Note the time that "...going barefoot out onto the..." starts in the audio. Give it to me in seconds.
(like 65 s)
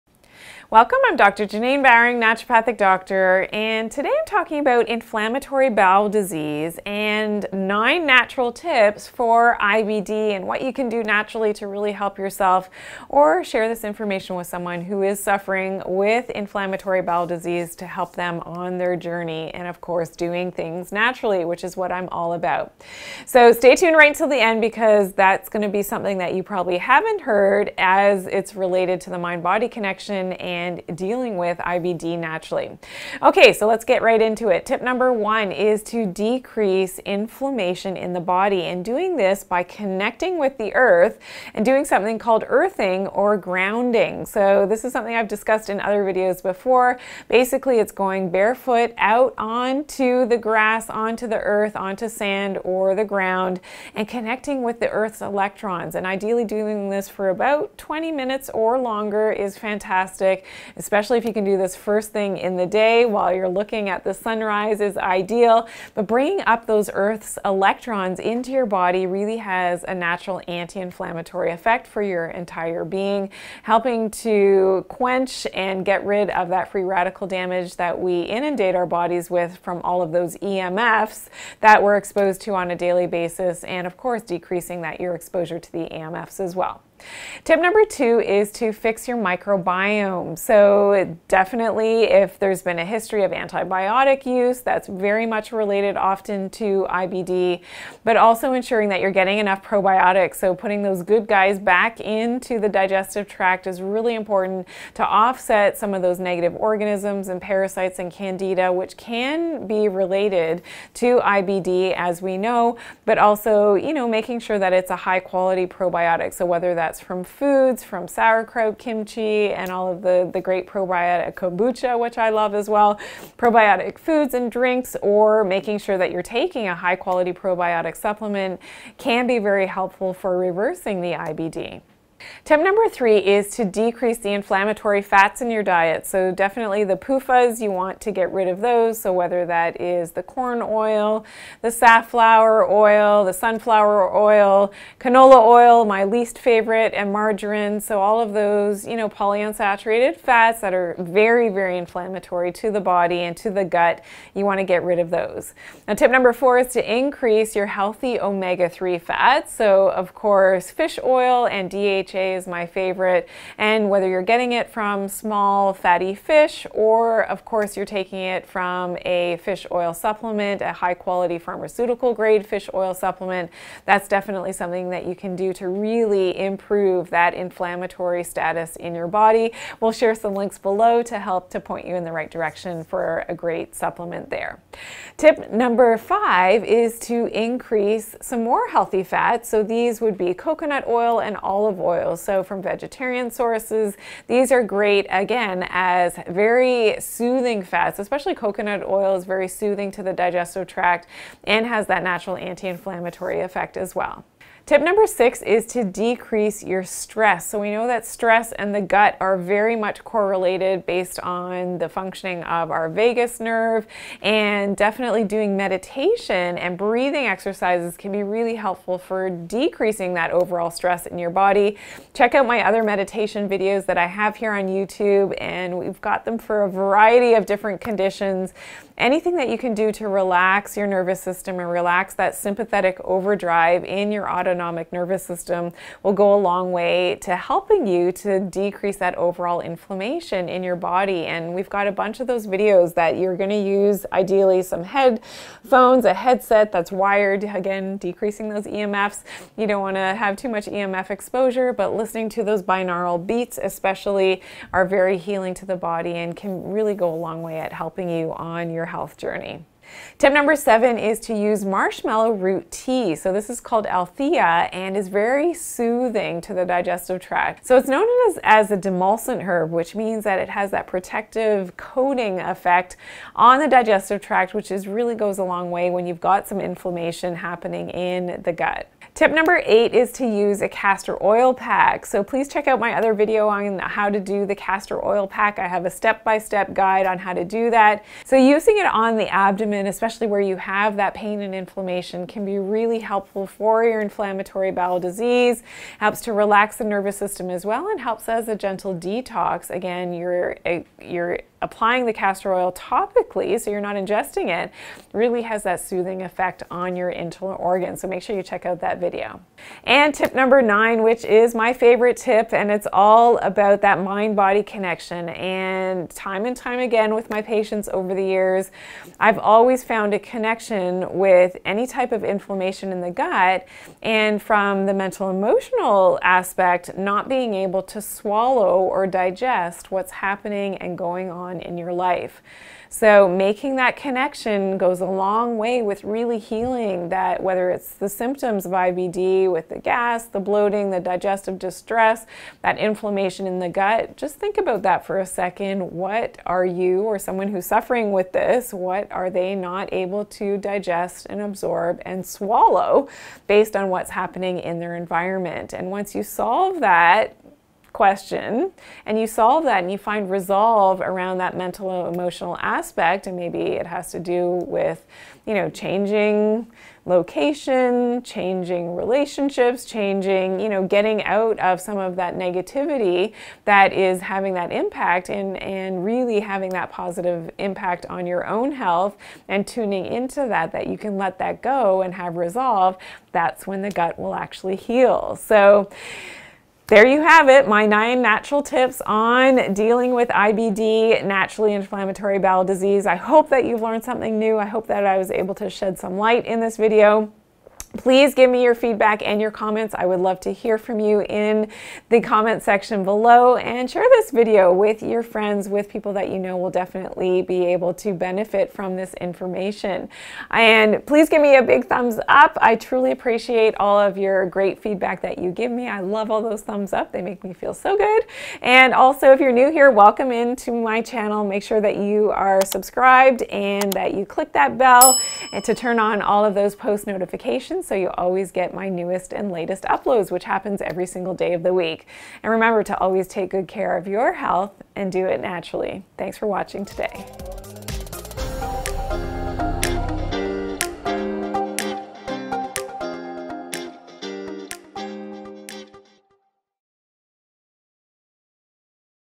47 s.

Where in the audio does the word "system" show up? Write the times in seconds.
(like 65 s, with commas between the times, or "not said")
231 s, 235 s, 297 s.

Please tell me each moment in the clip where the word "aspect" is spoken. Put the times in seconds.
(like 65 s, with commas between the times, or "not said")
326 s, 362 s.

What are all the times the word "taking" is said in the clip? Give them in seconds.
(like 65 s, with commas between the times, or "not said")
126 s, 167 s.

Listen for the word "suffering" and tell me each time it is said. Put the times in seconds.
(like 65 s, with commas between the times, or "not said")
15 s, 347 s.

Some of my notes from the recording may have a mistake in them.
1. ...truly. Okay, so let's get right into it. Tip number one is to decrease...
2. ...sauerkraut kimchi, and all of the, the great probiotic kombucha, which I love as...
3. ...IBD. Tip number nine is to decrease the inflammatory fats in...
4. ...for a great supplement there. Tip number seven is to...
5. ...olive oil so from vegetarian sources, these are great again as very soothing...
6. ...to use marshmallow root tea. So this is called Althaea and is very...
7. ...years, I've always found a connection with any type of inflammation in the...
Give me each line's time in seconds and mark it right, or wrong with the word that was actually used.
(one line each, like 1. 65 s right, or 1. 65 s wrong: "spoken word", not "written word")
1. 32 s wrong: "naturally", not "truly"
2. 118 s right
3. 131 s wrong: "three", not "nine"
4. 182 s wrong: "five", not "seven"
5. 191 s right
6. 261 s right
7. 318 s right.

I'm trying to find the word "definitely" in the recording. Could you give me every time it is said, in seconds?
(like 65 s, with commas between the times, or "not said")
91 s, 136 s, 174 s, 214 s, 406 s.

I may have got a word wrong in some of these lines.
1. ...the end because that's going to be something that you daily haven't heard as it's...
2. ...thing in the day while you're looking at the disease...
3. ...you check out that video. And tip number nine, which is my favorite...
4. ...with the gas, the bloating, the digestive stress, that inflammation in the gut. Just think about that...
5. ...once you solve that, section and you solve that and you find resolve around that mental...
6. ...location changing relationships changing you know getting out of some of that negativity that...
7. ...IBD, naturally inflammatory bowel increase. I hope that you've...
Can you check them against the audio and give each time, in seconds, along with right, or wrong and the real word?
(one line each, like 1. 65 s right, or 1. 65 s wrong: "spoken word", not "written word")
1. 24 s wrong: "probably", not "daily"
2. 62 s wrong: "sunrise", not "disease"
3. 308 s right
4. 339 s wrong: "distress", not "stress"
5. 355 s wrong: "question", not "section"
6. 367 s right
7. 390 s wrong: "disease", not "increase".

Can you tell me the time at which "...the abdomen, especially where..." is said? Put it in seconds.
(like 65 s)
289 s.